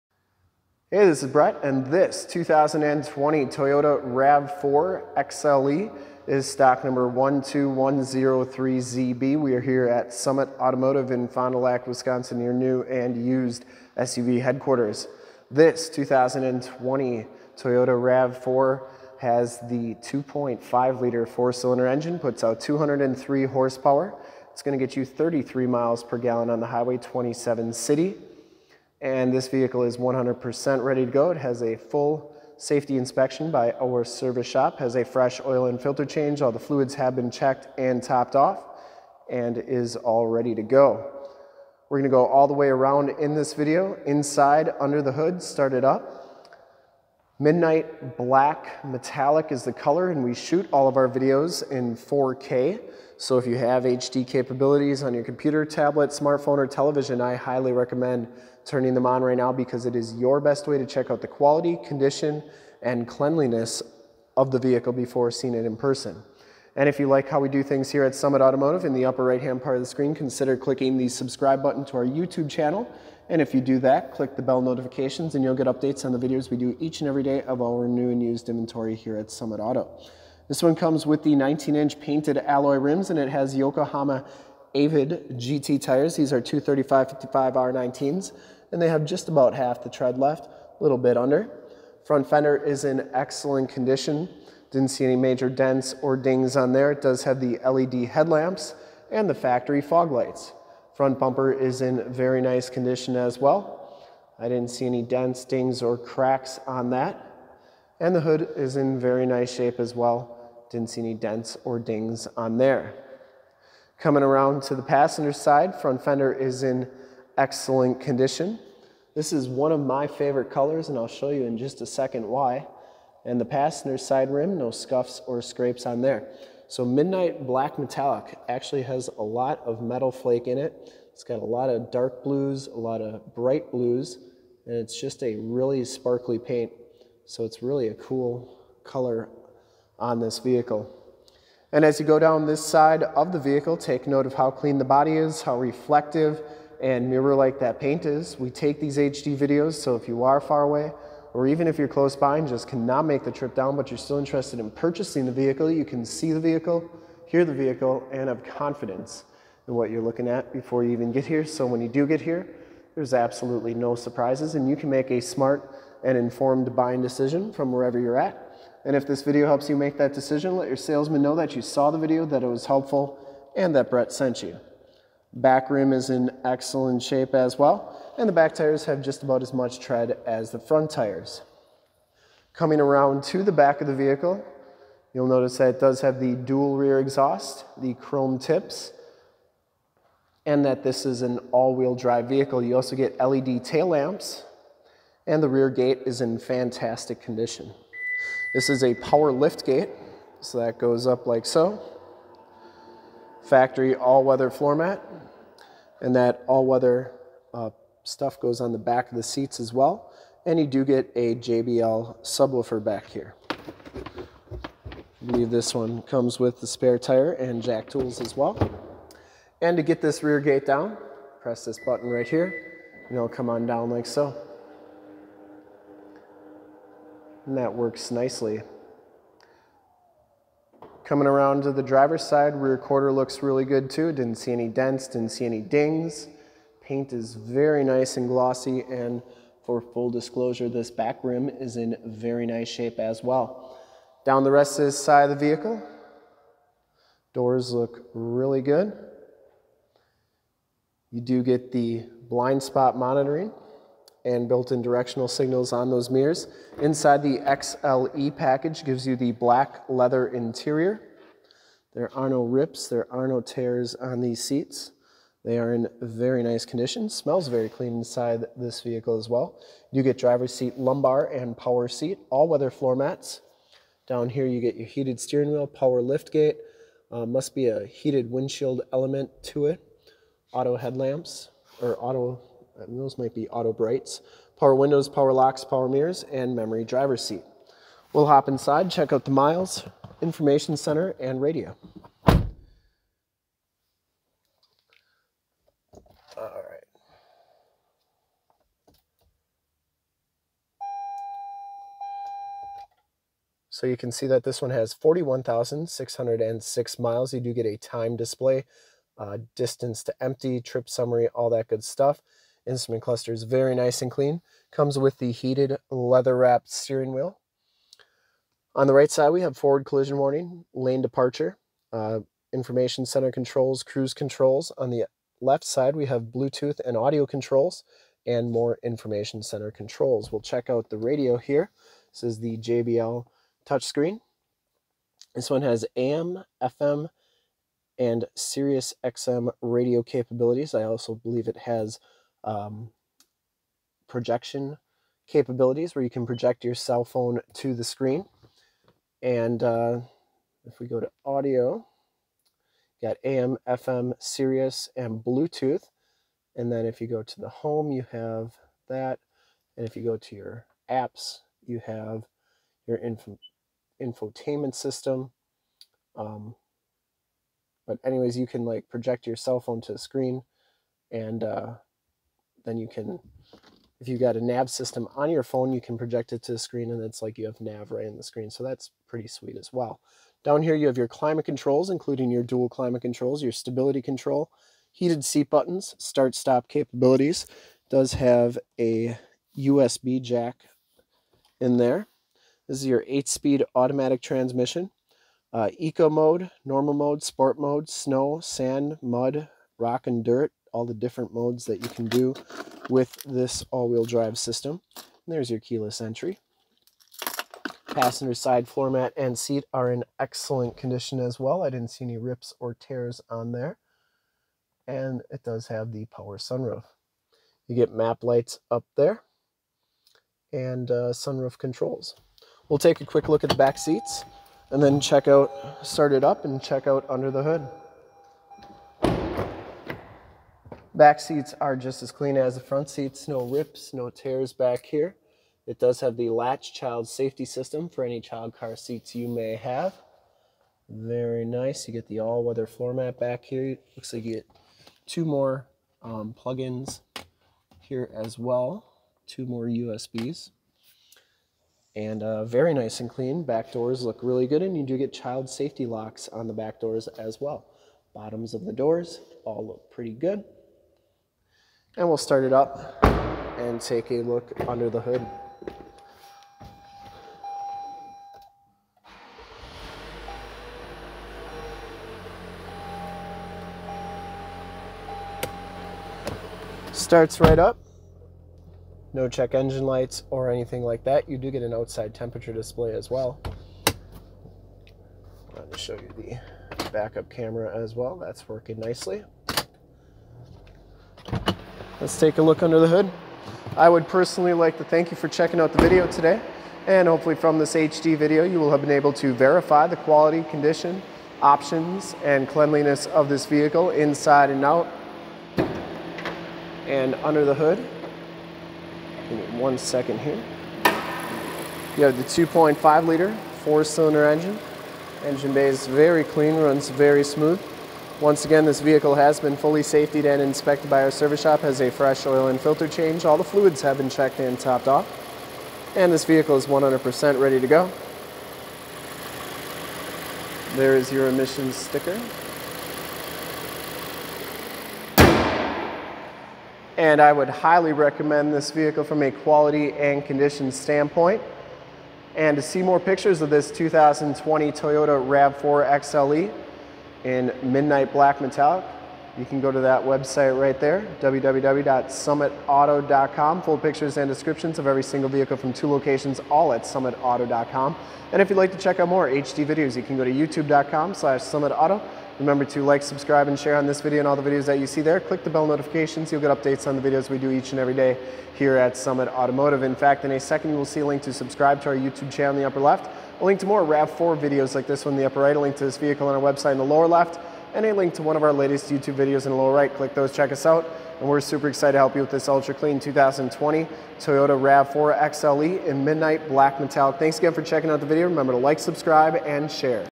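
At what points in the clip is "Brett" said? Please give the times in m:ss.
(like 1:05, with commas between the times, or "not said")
0:01, 2:53.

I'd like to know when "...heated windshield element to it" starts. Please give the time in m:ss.
4:37.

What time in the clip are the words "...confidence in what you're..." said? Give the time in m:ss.
2:38.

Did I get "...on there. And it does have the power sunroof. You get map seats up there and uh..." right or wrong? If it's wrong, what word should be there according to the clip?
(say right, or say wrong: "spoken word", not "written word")
wrong: "lights", not "seats".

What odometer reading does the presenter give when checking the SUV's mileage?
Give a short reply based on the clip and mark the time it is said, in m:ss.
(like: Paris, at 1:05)
41,606 miles, at 5:04.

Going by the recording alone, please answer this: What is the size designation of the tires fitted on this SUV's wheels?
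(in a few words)
235 55 R19.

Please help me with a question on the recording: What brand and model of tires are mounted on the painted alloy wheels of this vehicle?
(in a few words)
Yokohama Avid GT.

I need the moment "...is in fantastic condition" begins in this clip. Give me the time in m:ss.
3:16.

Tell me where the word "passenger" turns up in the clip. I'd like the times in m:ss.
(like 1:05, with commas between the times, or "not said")
1:54, 2:03, 6:47.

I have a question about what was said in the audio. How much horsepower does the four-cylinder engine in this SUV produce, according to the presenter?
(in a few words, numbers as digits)
203.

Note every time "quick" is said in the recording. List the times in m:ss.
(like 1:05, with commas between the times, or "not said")
7:03.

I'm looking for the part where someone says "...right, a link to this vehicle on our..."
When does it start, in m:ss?
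9:35.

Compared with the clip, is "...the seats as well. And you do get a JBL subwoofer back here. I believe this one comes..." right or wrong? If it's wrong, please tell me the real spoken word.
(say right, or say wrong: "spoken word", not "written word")
right.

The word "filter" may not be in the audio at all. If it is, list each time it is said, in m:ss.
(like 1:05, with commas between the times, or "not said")
0:35, 8:42.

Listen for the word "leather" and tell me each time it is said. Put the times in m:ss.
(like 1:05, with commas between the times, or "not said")
4:19, 5:15.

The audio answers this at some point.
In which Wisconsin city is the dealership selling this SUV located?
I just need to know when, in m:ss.
0:11.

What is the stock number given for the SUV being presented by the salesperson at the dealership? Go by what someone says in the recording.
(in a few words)
12103ZB.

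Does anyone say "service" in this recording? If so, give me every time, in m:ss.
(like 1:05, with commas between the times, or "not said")
0:34, 8:41.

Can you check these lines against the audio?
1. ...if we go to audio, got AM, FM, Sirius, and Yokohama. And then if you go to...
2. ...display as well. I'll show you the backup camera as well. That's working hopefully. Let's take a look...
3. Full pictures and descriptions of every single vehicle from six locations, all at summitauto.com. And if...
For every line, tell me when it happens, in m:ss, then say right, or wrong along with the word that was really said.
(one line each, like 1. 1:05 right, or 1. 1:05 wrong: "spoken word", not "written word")
1. 5:50 wrong: "Bluetooth", not "Yokohama"
2. 8:02 wrong: "nicely", not "hopefully"
3. 9:13 wrong: "two", not "six".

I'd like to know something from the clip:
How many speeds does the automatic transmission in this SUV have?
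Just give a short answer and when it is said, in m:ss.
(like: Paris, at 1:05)
8, at 6:33.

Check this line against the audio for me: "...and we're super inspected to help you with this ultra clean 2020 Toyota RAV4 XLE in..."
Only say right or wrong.
wrong.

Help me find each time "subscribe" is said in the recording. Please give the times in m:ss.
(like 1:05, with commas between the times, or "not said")
1:11, 9:23, 9:31, 9:48.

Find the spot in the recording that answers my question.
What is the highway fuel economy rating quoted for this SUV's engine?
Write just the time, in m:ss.
0:25.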